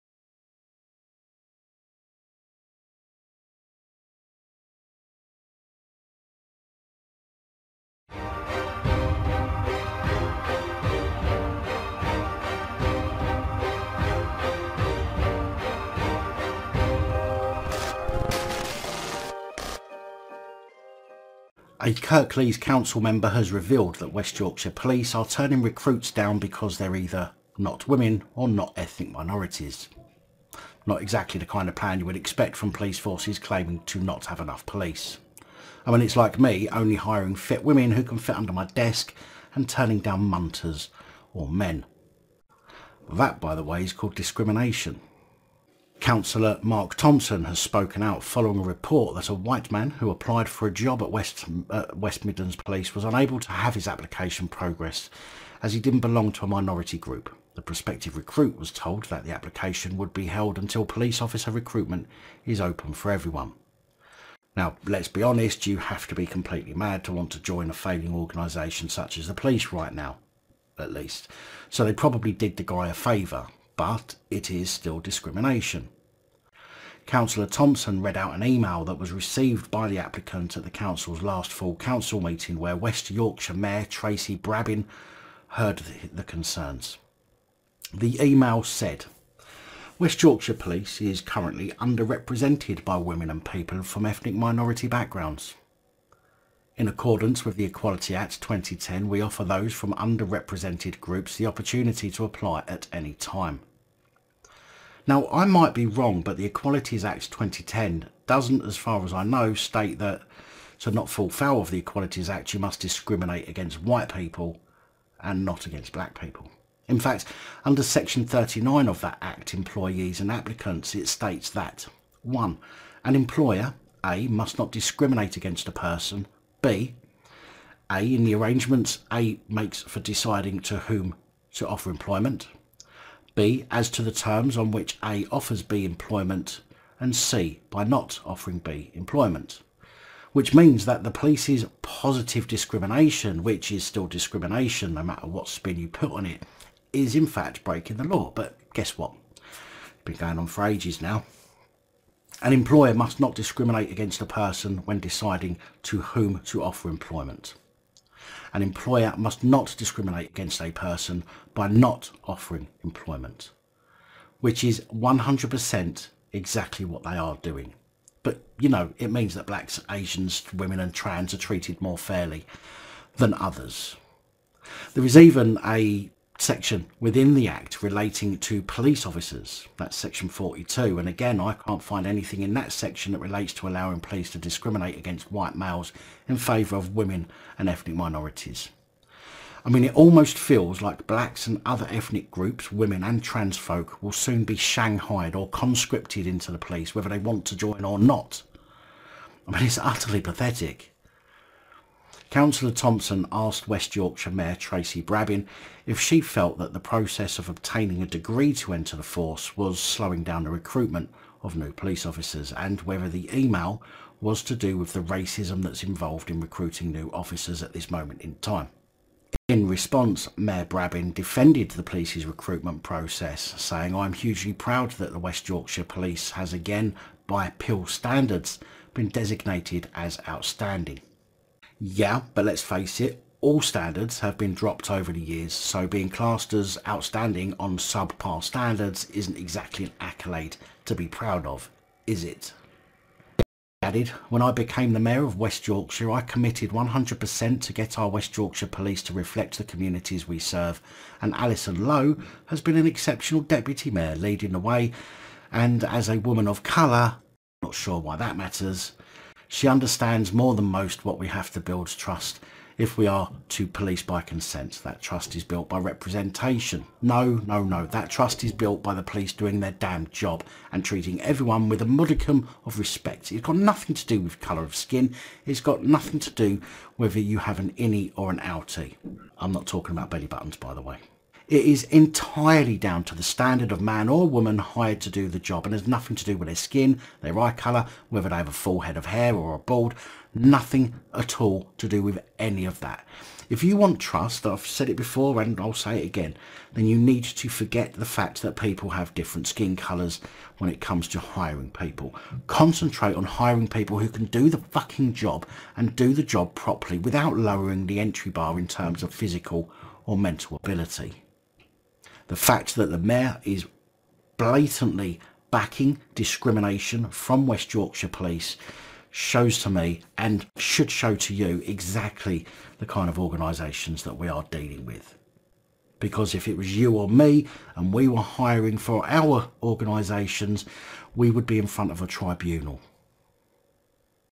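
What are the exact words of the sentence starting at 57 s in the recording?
The prospective recruit was told that the application would be held until police officer recruitment is open for everyone.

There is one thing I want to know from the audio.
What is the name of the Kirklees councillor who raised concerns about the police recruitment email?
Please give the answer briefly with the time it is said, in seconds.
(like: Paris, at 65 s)
Mark Thompson, at 46 s.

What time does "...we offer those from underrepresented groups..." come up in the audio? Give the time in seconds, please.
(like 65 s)
99 s.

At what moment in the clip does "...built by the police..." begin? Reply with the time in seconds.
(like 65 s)
268 s.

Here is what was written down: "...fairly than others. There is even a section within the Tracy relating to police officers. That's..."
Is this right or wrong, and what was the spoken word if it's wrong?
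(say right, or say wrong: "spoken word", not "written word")
wrong: "Act", not "Tracy".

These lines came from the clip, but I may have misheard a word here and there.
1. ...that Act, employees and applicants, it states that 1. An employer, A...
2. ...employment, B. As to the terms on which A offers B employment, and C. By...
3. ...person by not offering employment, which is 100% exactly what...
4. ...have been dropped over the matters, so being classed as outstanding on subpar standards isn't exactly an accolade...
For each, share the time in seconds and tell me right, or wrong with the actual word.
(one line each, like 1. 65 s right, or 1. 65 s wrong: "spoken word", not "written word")
1. 119 s right
2. 131 s right
3. 160 s right
4. 234 s wrong: "years", not "matters".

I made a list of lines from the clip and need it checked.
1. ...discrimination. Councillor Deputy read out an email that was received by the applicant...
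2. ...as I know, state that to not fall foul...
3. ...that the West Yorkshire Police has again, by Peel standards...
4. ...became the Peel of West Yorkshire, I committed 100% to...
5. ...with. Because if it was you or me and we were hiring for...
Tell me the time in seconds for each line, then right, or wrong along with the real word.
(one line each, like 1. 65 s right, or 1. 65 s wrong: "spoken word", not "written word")
1. 74 s wrong: "Thompson", not "Deputy"
2. 109 s right
3. 224 s right
4. 244 s wrong: "Mayor", not "Peel"
5. 324 s right.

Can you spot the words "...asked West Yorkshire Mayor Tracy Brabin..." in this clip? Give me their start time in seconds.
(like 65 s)
203 s.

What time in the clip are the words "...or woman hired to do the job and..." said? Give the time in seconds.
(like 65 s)
284 s.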